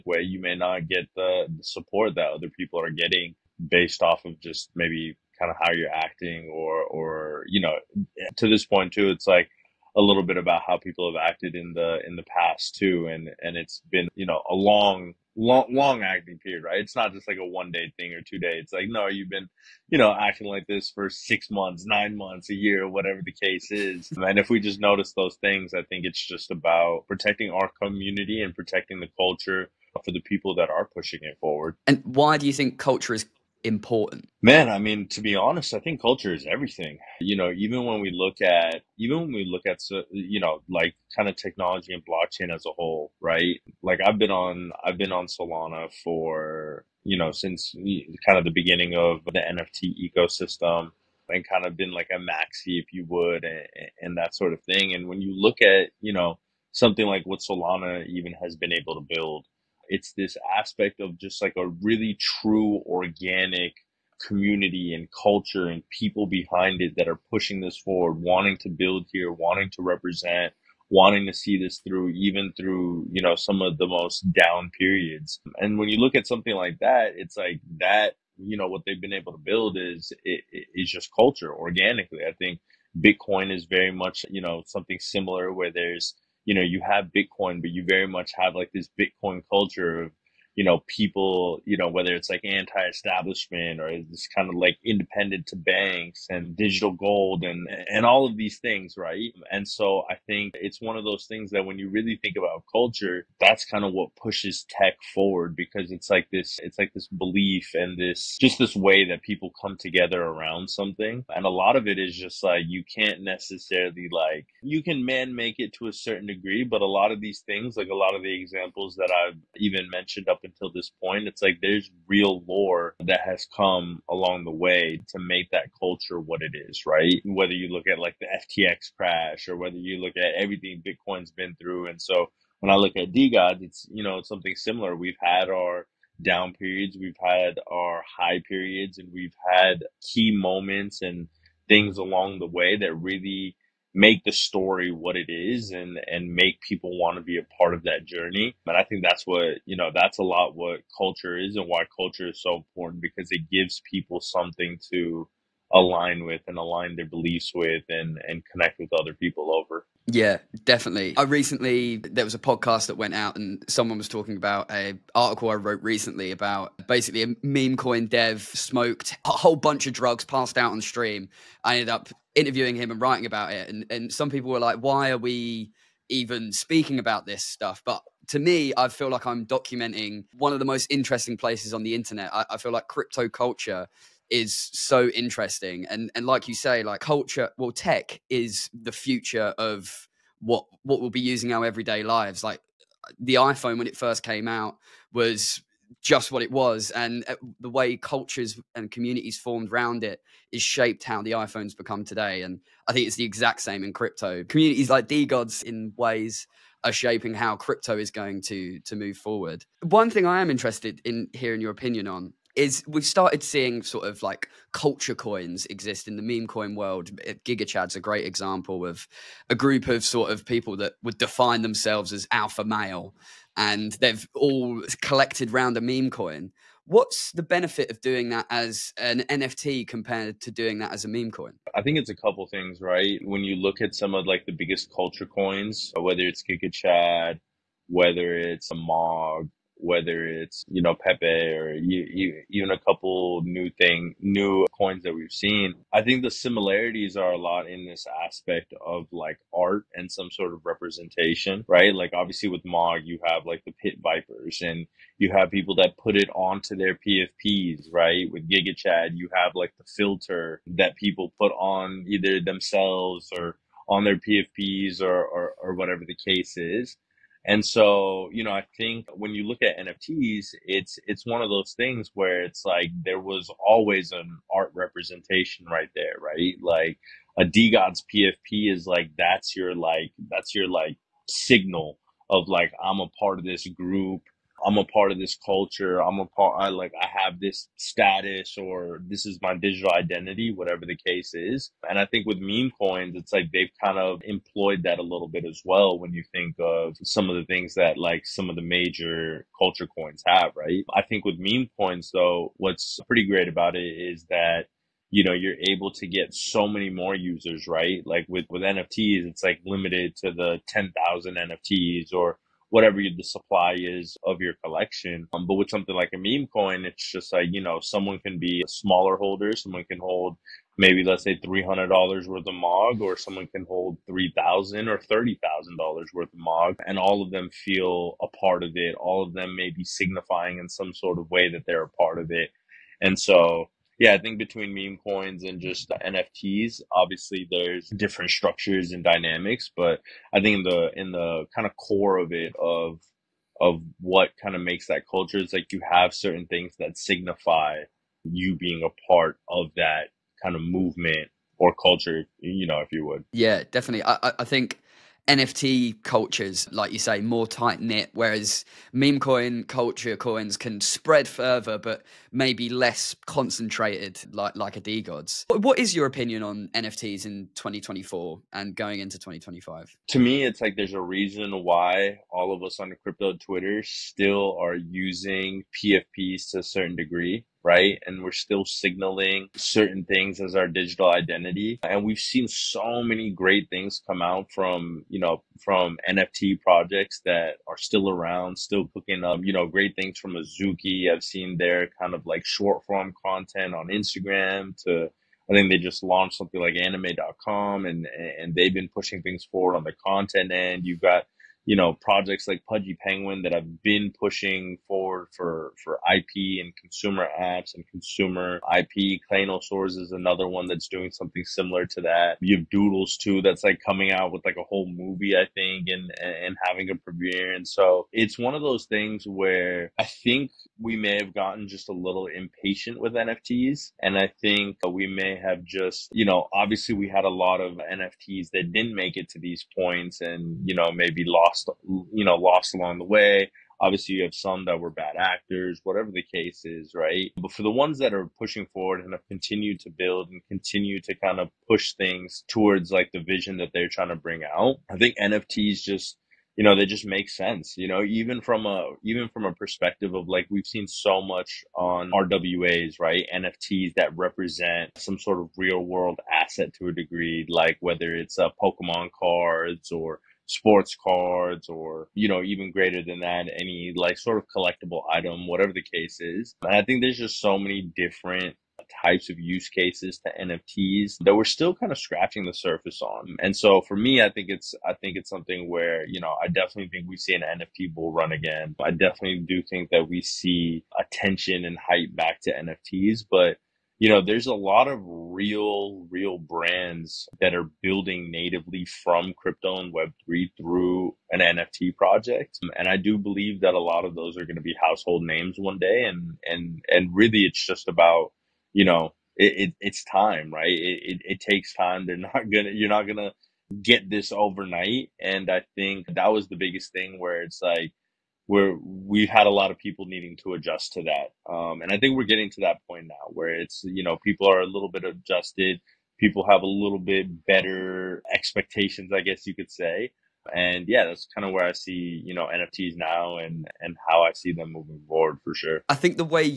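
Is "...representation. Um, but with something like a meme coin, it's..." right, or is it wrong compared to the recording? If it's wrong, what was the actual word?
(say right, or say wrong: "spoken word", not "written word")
wrong: "collection", not "representation".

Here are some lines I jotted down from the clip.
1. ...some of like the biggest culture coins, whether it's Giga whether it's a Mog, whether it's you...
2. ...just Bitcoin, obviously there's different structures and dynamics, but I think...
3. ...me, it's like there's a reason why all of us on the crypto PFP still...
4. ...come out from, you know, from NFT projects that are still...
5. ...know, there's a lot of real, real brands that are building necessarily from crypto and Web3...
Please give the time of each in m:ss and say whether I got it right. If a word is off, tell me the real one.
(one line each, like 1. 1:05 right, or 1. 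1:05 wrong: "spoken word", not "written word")
1. 3:53 right
2. 5:35 wrong: "NFTs", not "Bitcoin"
3. 6:10 wrong: "Twitter", not "PFP"
4. 6:24 right
5. 8:04 wrong: "natively", not "necessarily".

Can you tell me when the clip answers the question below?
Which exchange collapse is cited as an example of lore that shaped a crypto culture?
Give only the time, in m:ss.
2:08.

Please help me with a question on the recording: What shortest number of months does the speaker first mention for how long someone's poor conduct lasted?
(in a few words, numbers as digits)
6 months.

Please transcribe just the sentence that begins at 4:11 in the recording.
Like obviously with Mog, you have like the Pit Vipers and you have people that put it onto their PFPs, right?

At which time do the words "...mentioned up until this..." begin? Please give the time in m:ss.
1:59.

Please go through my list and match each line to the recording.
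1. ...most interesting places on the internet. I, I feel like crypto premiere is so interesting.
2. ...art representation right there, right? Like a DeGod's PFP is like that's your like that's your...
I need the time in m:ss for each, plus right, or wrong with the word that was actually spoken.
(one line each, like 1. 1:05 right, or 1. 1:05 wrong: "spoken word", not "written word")
1. 3:00 wrong: "culture", not "premiere"
2. 4:34 right.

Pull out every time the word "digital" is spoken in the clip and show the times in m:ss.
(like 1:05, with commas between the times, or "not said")
1:36, 4:49, 6:20.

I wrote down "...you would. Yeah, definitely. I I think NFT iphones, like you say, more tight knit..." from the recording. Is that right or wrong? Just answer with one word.
wrong.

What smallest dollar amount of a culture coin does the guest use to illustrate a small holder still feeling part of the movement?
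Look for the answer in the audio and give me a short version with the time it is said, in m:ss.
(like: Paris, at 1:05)
$300, at 5:21.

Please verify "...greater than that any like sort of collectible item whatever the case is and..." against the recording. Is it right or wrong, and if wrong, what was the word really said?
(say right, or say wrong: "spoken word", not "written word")
right.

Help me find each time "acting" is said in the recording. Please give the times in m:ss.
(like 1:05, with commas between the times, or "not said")
0:05, 0:16, 0:20.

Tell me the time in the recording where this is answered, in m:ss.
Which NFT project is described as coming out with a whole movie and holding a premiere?
6:52.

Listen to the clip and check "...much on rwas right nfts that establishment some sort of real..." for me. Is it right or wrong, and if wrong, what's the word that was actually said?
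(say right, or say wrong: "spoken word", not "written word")
wrong: "represent", not "establishment".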